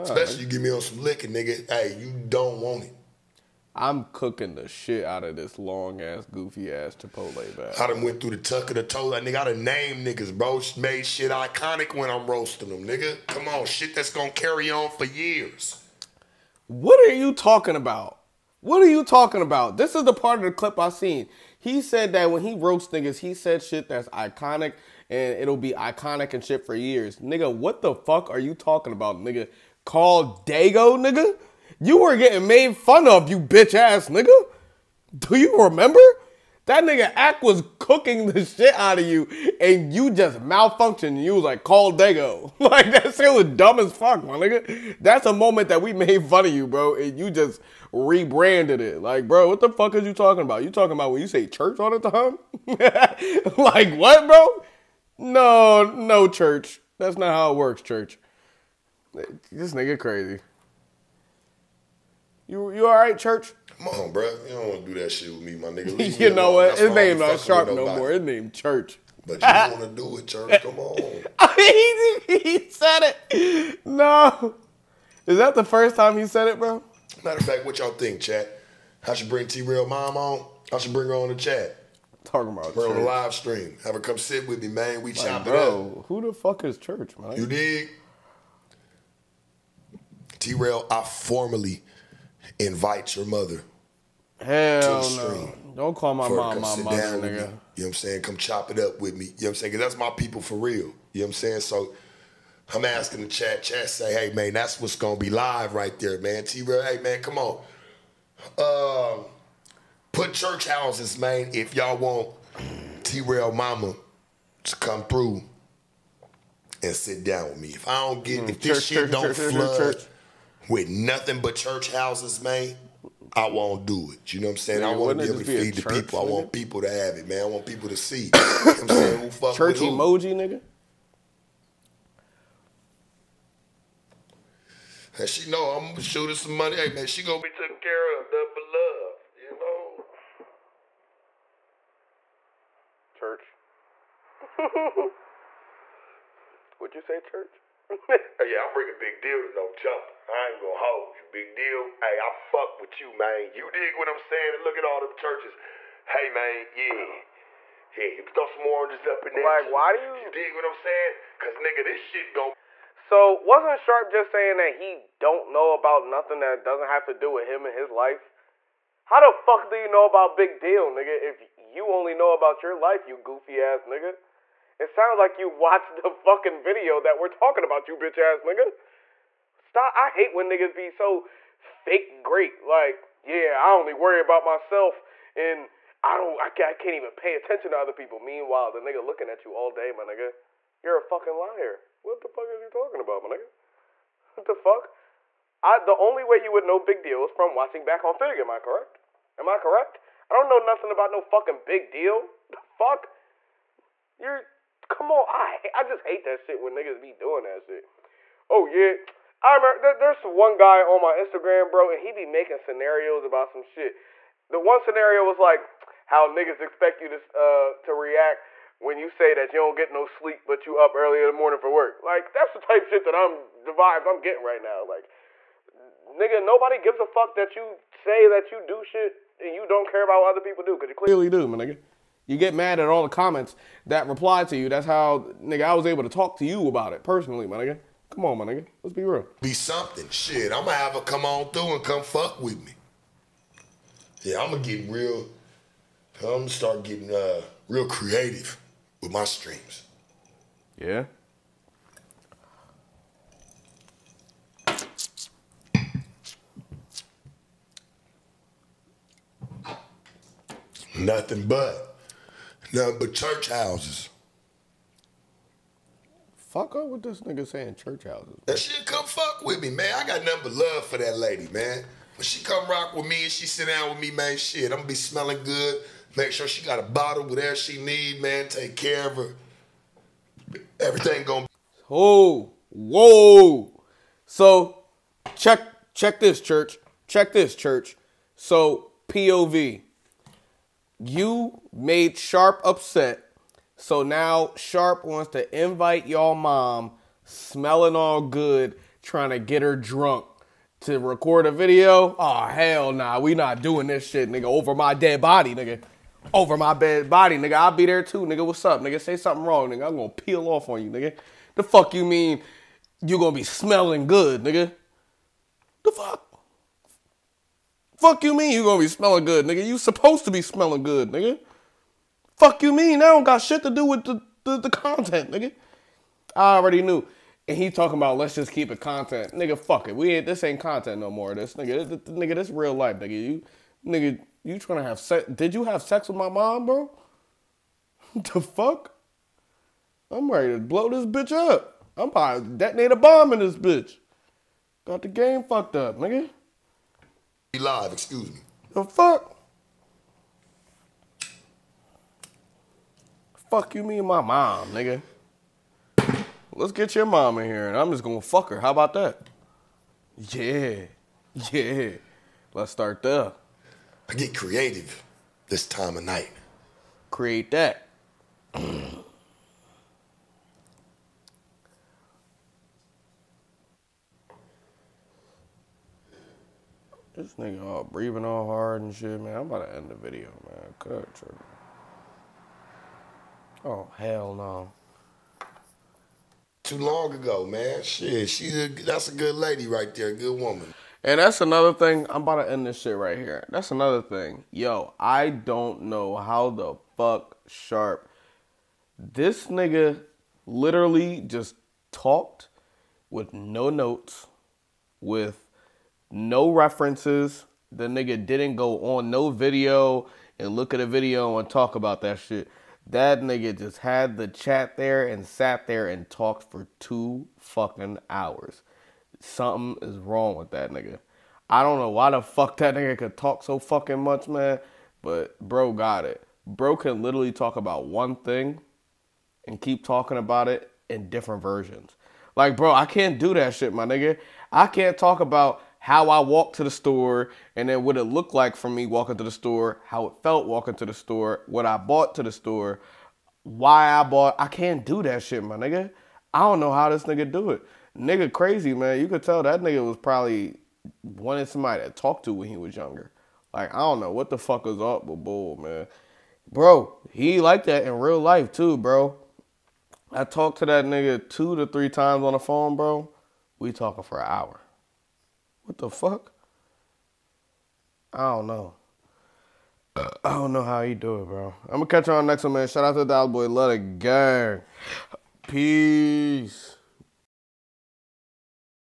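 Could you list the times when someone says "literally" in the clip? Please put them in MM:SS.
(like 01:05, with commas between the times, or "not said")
06:40, 07:07.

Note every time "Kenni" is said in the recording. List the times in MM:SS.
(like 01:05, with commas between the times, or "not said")
not said.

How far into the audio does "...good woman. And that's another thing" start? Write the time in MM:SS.
06:30.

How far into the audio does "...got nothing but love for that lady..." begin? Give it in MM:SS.
04:30.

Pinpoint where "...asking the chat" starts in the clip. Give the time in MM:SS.
01:42.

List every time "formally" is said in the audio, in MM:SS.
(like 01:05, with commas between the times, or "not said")
01:31.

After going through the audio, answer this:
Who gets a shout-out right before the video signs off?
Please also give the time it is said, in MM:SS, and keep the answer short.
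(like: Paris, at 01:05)
Dollar Boy, at 07:53.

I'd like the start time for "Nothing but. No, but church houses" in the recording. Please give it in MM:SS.
04:20.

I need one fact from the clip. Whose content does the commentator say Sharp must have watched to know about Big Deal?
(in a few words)
Figure.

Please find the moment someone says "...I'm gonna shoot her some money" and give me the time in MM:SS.
02:15.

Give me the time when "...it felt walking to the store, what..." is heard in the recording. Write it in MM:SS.
07:20.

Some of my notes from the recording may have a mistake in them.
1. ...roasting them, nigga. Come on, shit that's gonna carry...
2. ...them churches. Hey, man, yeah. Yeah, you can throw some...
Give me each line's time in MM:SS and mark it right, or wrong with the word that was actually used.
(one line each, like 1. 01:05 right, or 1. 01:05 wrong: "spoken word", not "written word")
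1. 00:12 right
2. 02:35 right.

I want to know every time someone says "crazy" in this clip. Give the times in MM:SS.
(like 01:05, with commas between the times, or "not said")
00:59, 07:28.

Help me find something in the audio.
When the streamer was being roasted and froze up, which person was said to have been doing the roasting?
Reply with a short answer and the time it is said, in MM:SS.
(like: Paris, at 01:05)
Ack, at 00:37.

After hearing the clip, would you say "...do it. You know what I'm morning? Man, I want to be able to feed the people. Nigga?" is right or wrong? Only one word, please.
wrong.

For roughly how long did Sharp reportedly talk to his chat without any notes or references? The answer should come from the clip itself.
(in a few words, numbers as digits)
2 hours.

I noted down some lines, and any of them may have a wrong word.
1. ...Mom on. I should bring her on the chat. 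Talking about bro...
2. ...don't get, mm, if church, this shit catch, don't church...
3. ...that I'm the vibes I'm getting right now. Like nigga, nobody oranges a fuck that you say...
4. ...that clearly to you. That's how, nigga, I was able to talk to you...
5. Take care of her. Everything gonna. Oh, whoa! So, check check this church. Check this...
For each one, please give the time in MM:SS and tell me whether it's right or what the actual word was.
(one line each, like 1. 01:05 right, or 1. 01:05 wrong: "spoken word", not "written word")
1. 01:19 right
2. 01:58 wrong: "church", not "catch"
3. 03:43 wrong: "gives", not "oranges"
4. 03:53 wrong: "reply", not "clearly"
5. 04:38 right.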